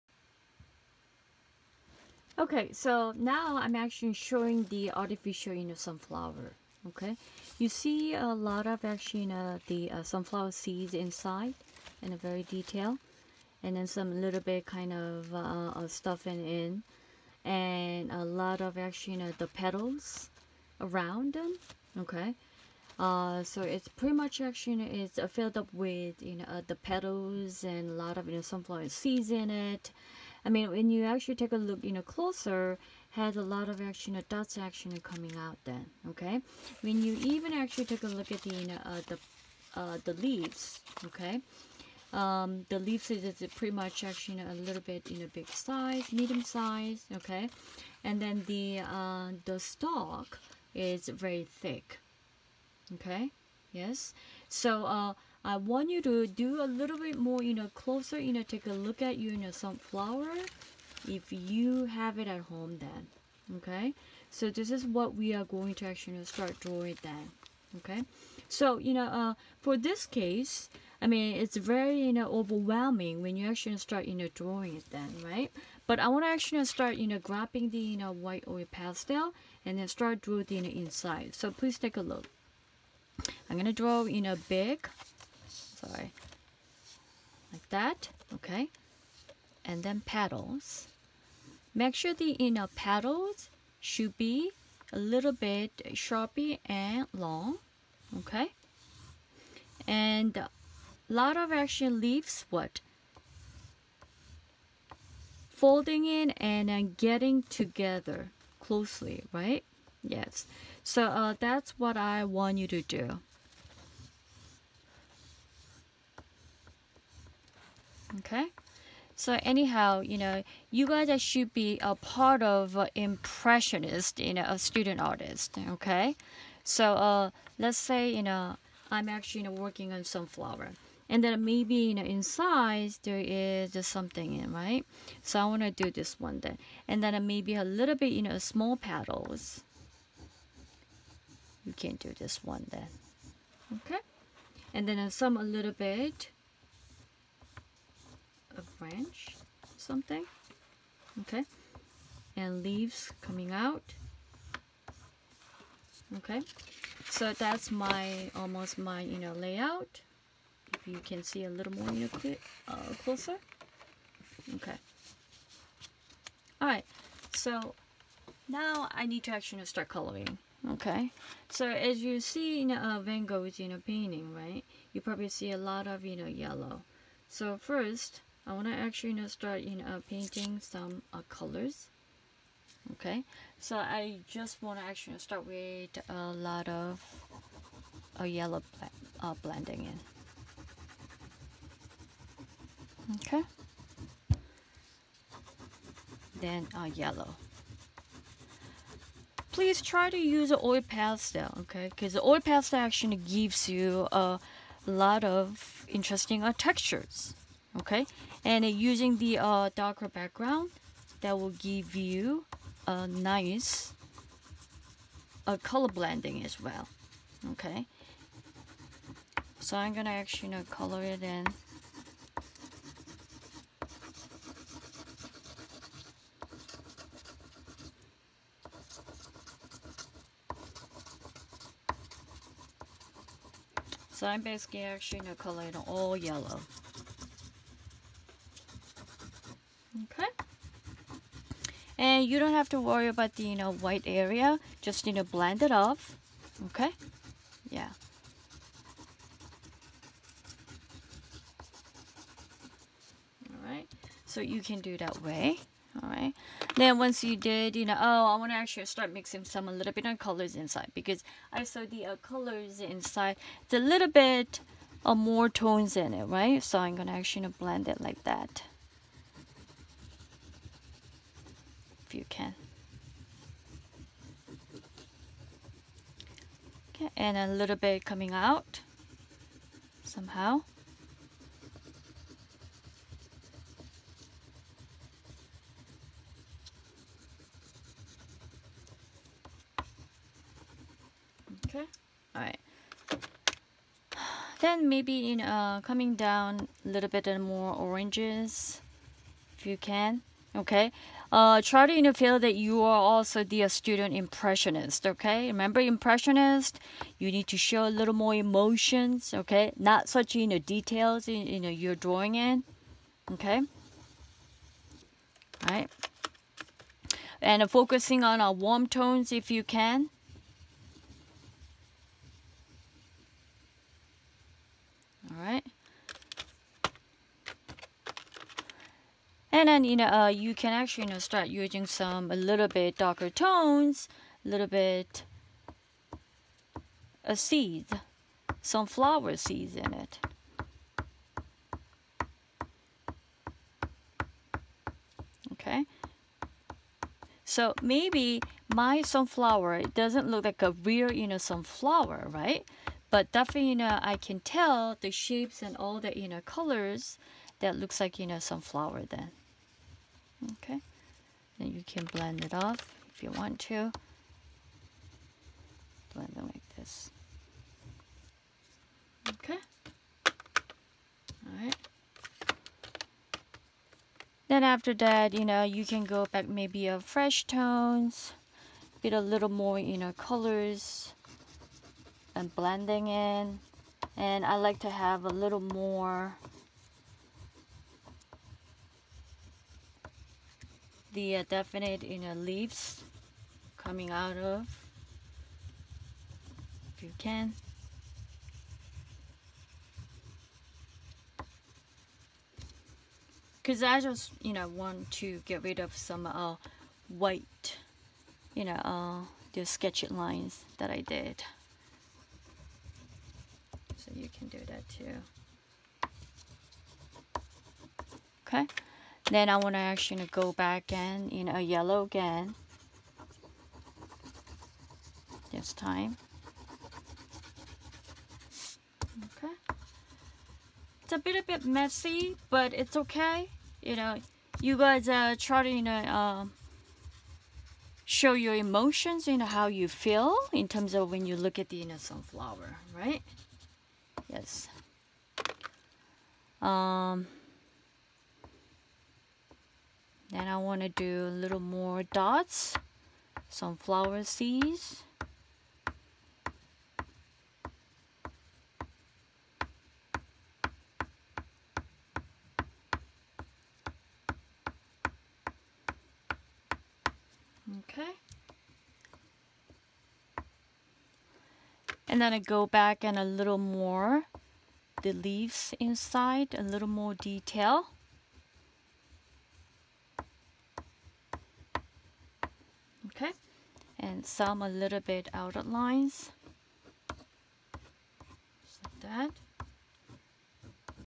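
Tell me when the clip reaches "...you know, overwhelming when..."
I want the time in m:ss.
1:11.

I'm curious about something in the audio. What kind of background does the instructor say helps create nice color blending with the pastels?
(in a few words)
darker background.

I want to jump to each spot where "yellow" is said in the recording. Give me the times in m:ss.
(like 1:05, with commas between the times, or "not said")
2:56, 3:08, 3:16, 3:56, 7:01.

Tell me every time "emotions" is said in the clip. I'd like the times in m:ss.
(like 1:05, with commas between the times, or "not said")
5:08, 7:18.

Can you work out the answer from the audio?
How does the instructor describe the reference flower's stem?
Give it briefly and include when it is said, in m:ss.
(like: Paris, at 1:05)
very thick, at 0:51.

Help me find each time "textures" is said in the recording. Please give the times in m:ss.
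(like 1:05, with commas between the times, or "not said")
3:26.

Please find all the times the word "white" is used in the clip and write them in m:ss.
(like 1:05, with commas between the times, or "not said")
1:18, 4:03, 6:47.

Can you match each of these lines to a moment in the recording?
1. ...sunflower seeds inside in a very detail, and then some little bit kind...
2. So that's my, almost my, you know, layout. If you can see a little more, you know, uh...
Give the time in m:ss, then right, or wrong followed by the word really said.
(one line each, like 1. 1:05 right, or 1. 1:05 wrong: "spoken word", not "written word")
1. 0:10 right
2. 2:37 right.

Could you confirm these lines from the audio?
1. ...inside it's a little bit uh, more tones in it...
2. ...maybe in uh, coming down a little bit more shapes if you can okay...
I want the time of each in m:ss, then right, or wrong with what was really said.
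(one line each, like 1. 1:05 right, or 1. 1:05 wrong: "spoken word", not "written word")
1. 4:22 right
2. 4:54 wrong: "oranges", not "shapes".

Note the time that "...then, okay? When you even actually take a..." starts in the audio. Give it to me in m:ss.
0:35.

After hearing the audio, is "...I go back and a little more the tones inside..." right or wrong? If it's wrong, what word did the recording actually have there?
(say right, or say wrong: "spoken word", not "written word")
wrong: "leaves", not "tones".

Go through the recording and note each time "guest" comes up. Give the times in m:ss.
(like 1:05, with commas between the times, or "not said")
not said.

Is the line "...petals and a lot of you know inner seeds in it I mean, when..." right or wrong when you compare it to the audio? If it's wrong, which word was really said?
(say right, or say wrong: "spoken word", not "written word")
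wrong: "sunflower", not "inner".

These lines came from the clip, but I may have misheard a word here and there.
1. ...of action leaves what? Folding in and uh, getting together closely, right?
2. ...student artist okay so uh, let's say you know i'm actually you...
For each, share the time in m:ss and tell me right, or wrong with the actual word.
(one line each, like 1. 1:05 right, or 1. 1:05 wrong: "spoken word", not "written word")
1. 1:41 right
2. 2:04 right.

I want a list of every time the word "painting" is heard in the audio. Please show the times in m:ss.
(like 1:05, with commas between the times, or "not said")
2:53, 3:00.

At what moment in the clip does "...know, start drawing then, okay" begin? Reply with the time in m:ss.
1:06.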